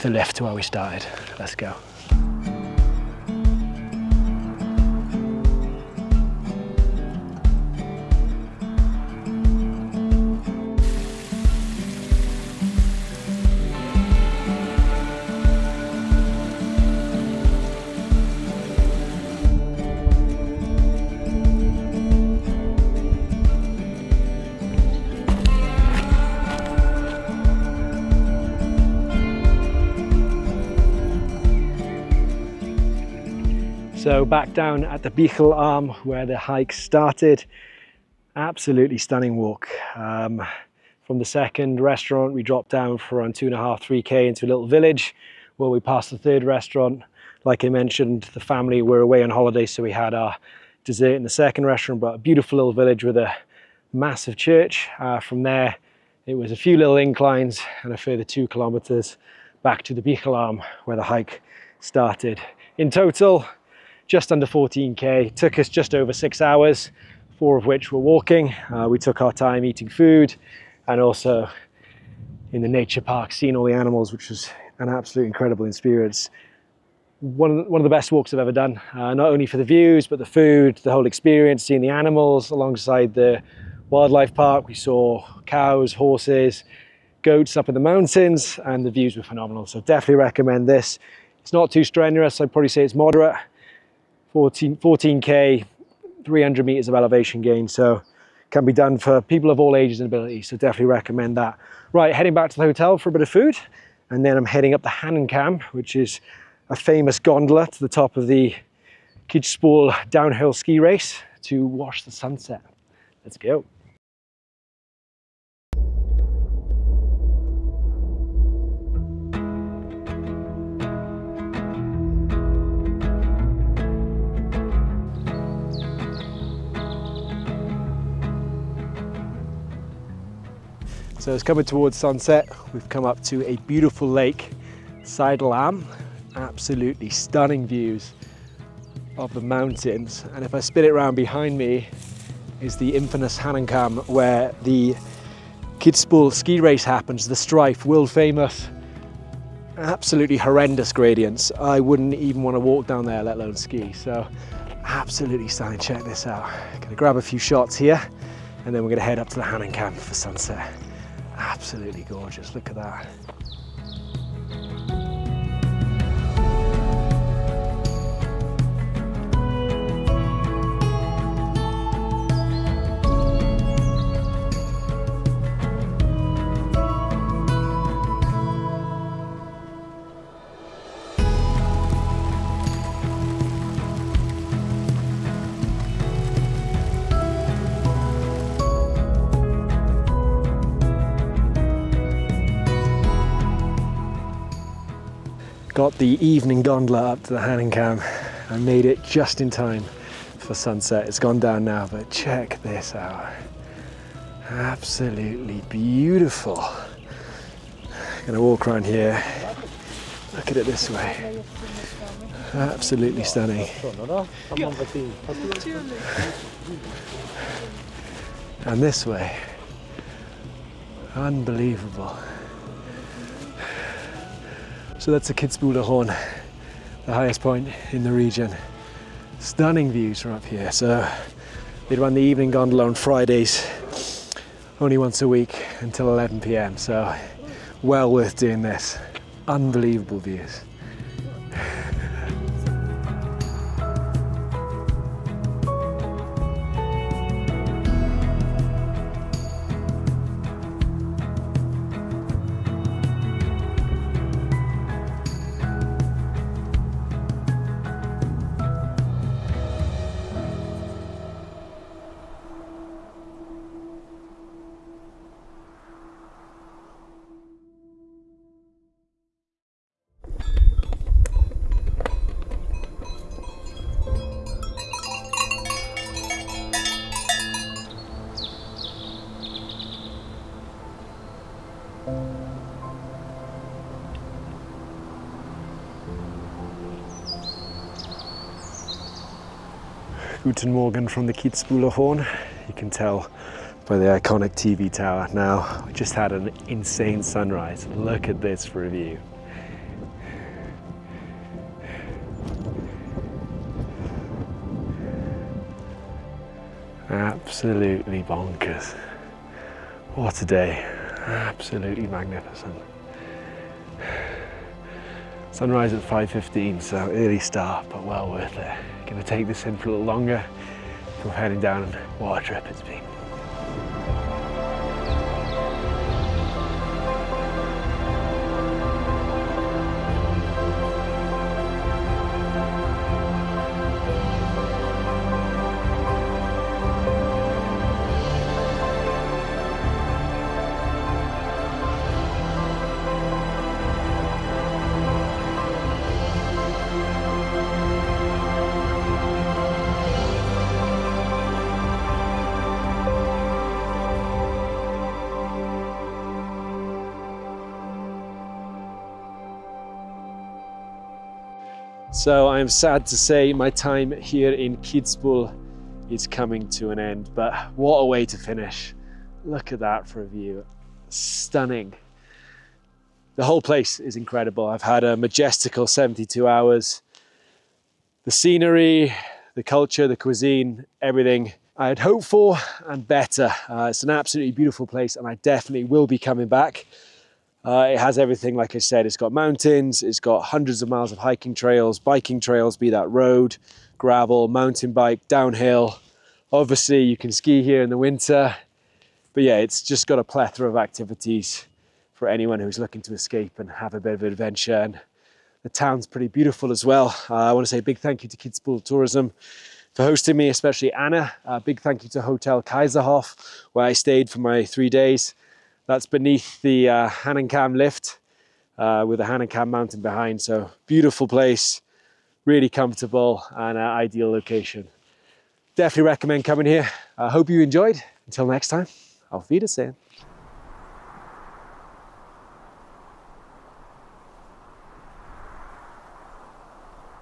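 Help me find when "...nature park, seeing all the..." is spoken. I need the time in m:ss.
1:12.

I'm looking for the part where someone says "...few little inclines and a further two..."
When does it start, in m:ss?
0:56.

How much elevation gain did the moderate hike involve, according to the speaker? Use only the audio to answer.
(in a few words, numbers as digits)
300 meters.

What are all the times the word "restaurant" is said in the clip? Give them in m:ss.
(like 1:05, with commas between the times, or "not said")
0:41, 0:46, 0:51.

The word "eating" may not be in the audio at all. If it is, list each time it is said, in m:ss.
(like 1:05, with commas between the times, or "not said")
1:09.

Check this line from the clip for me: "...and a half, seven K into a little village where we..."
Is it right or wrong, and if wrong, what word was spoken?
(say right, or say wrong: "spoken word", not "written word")
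wrong: "three", not "seven".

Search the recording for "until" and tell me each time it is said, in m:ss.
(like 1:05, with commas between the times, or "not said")
3:55, 7:08.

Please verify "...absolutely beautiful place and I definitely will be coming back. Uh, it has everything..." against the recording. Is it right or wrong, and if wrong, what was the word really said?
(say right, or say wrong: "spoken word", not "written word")
right.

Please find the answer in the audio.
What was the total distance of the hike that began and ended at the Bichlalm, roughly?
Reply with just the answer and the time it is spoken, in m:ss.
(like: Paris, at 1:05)
just under 14k, at 1:04.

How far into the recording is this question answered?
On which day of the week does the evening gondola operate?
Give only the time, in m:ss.
3:52.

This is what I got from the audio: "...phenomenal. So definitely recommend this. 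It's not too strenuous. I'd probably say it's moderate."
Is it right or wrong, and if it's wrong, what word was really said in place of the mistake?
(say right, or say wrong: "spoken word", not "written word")
right.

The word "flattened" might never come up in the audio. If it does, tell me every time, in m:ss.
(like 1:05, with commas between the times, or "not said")
not said.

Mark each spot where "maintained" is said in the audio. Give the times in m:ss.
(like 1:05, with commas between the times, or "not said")
not said.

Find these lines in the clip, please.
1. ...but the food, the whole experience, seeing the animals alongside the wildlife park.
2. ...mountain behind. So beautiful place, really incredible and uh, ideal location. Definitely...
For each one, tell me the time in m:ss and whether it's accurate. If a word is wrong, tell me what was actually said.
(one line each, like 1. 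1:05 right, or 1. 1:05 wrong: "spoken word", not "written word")
1. 1:20 right
2. 6:59 wrong: "comfortable", not "incredible".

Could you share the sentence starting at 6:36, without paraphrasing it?
Obviously, you can ski here in the winter.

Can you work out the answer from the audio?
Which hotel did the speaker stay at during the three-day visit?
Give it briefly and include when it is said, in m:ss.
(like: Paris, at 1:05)
Hotel Kaiserhof, at 6:52.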